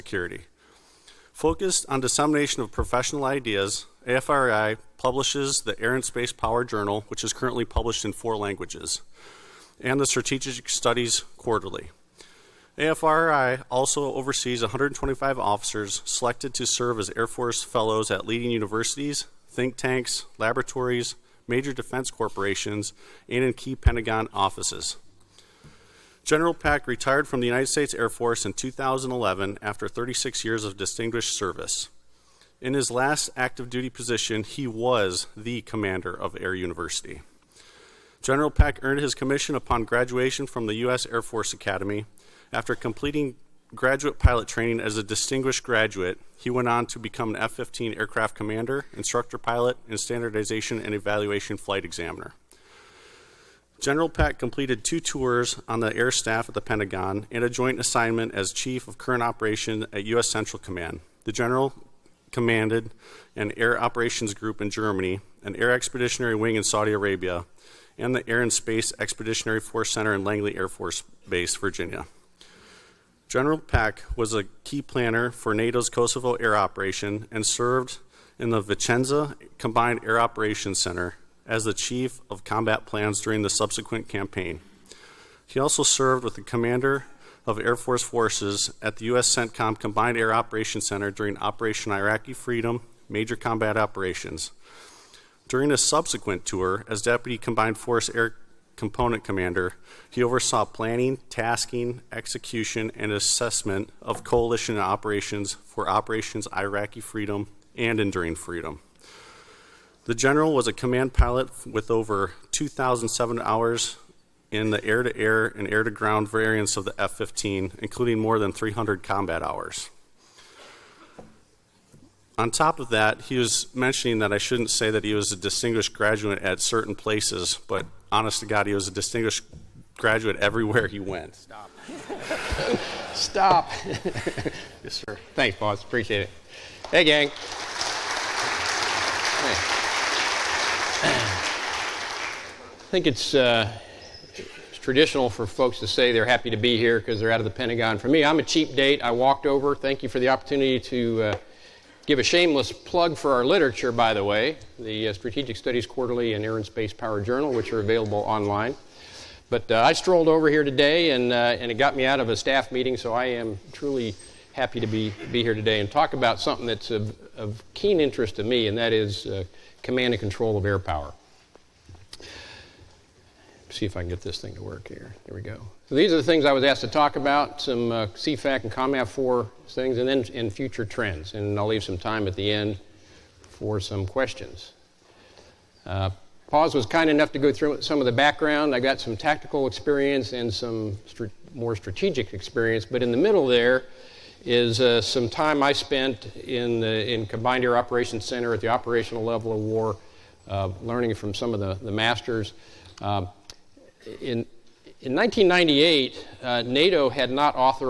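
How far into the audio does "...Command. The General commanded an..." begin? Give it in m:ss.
1:00.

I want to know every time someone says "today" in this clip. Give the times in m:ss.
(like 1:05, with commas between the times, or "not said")
2:40, 2:45.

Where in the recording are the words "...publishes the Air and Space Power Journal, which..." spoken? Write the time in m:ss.
0:04.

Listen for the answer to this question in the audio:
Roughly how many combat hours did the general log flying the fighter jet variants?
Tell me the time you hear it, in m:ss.
1:58.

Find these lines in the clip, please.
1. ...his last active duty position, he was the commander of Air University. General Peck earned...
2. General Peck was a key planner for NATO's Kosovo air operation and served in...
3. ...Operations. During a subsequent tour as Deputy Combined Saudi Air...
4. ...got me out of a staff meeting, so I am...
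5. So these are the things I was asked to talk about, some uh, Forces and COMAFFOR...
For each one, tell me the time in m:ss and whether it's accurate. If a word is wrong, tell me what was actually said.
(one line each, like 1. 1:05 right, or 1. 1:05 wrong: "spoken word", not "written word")
1. 0:32 right
2. 1:13 right
3. 1:33 wrong: "Force", not "Saudi"
4. 2:41 right
5. 2:55 wrong: "CFAC", not "Forces".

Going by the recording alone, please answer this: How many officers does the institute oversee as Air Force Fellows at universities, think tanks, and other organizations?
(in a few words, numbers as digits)
125.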